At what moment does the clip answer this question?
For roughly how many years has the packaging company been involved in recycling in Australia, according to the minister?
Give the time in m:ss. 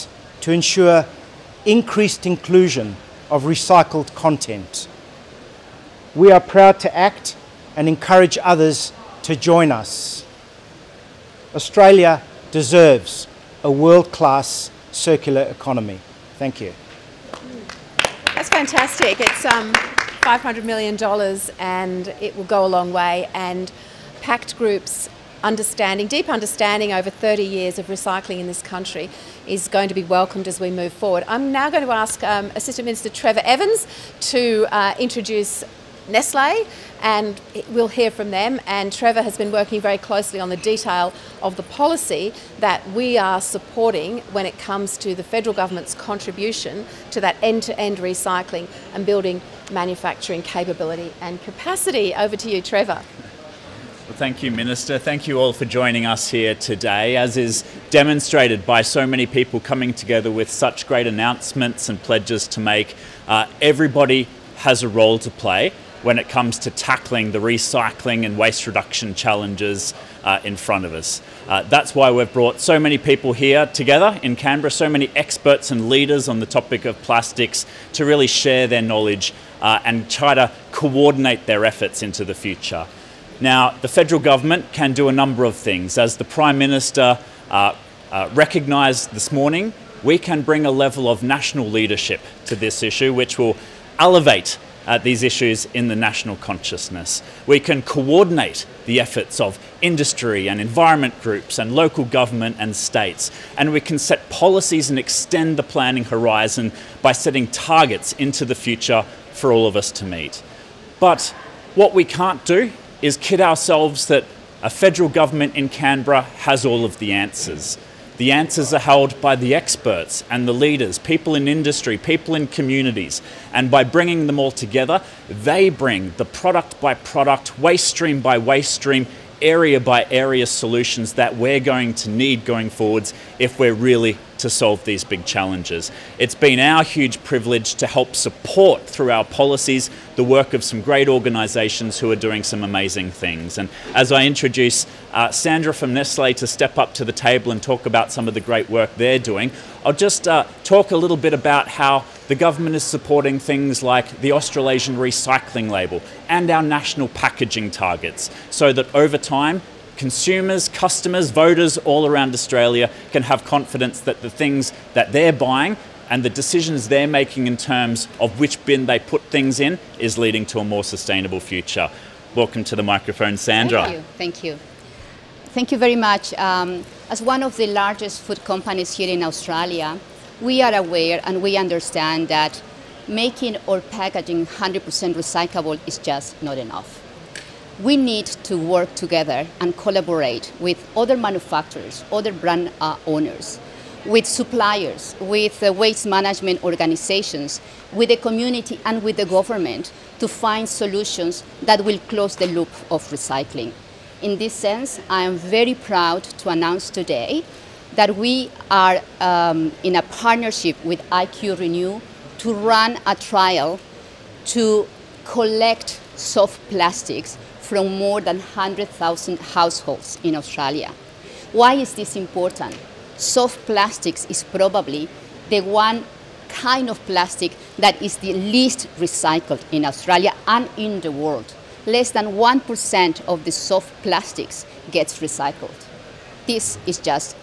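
0:27.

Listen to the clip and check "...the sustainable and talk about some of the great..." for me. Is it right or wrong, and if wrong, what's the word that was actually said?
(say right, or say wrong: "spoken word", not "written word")
wrong: "table", not "sustainable".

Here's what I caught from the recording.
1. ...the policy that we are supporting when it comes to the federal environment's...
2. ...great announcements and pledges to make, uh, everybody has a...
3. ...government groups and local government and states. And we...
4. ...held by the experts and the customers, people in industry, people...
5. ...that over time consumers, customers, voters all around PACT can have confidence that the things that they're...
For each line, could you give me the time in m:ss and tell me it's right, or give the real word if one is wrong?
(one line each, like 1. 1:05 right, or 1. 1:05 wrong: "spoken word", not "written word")
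1. 0:41 wrong: "government", not "environment"
2. 1:00 right
3. 1:40 wrong: "environment", not "government"
4. 1:58 wrong: "leaders", not "customers"
5. 2:38 wrong: "Australia", not "PACT".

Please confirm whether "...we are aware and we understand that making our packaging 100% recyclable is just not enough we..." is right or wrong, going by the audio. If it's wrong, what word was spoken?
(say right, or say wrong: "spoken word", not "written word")
right.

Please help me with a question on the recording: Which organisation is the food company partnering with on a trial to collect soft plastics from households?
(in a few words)
IQ Renew.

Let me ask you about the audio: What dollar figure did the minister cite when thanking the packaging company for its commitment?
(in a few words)
$500 million.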